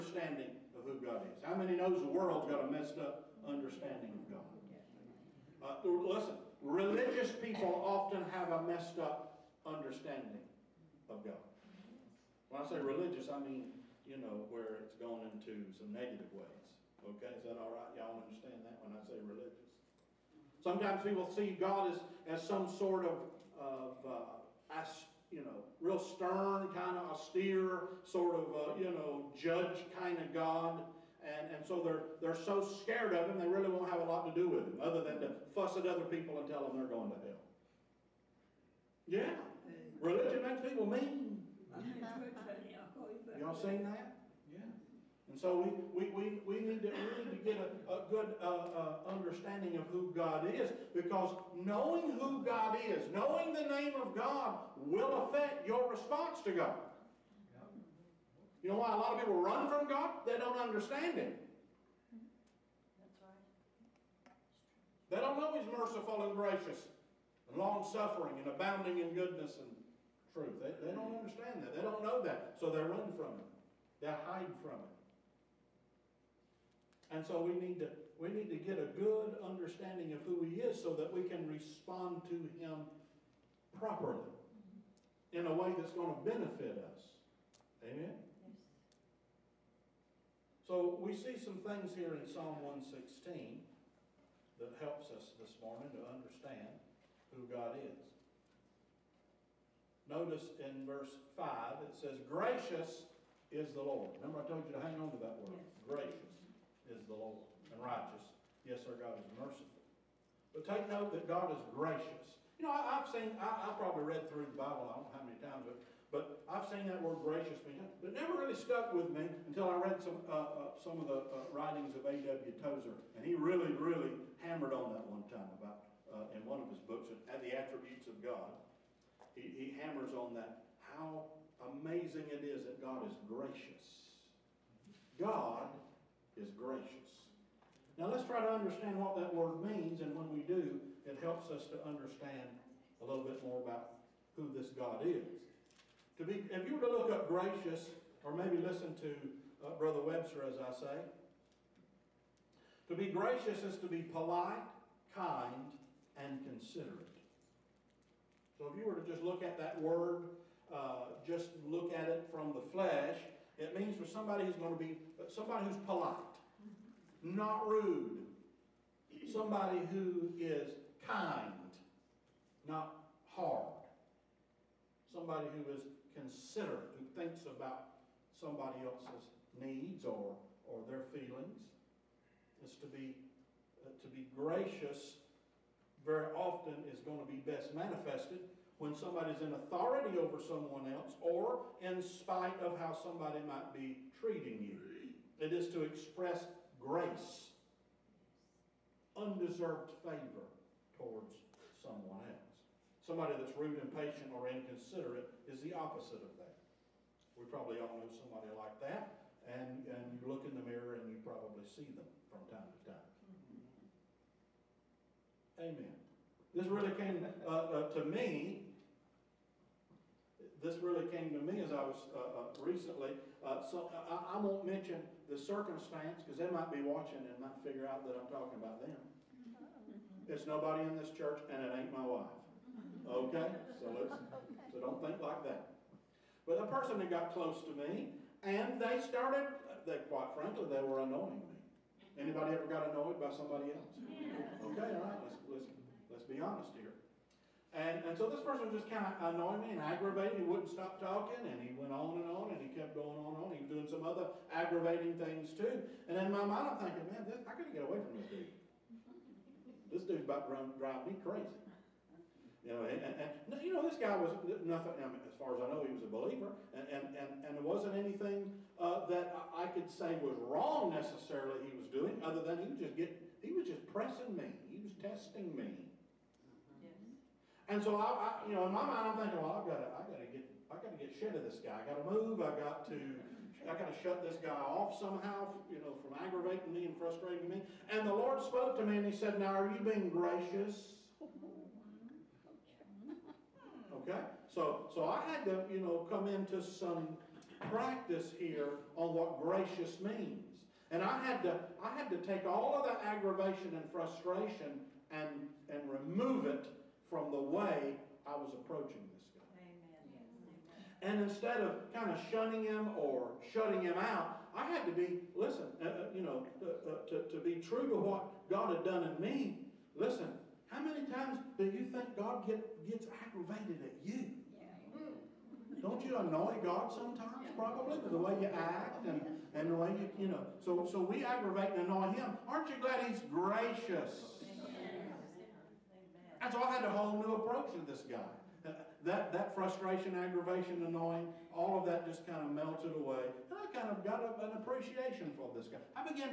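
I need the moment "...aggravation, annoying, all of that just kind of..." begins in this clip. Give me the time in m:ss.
5:40.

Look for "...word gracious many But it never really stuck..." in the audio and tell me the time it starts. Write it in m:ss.
1:57.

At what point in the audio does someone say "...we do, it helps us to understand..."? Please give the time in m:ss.
2:20.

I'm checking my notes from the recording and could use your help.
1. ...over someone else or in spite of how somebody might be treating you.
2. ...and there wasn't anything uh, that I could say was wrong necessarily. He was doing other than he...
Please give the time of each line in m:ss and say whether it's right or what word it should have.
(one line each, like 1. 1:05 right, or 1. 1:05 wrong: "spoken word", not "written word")
1. 3:10 right
2. 4:27 right.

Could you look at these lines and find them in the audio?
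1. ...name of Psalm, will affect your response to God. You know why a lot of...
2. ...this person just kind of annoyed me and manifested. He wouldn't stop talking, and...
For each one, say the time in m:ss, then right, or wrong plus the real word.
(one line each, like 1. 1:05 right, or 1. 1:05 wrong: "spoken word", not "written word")
1. 0:53 wrong: "God", not "Psalm"
2. 4:08 wrong: "aggravated", not "manifested".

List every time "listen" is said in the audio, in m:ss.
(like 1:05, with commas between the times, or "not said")
0:05, 2:28, 5:15, 5:19.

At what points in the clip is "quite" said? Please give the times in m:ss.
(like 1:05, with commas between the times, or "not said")
4:00.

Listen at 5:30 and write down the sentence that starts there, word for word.
So, so we aggravate and annoy Him.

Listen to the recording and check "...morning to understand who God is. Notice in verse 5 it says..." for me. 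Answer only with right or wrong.
right.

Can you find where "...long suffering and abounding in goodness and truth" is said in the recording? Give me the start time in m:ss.
1:07.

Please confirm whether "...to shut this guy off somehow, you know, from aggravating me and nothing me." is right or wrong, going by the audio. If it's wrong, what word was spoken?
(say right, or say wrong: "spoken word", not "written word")
wrong: "frustrating", not "nothing".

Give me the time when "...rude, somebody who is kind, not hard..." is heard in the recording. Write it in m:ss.
2:47.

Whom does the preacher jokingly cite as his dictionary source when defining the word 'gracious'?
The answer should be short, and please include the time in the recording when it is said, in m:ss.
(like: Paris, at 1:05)
Brother Webster, at 2:29.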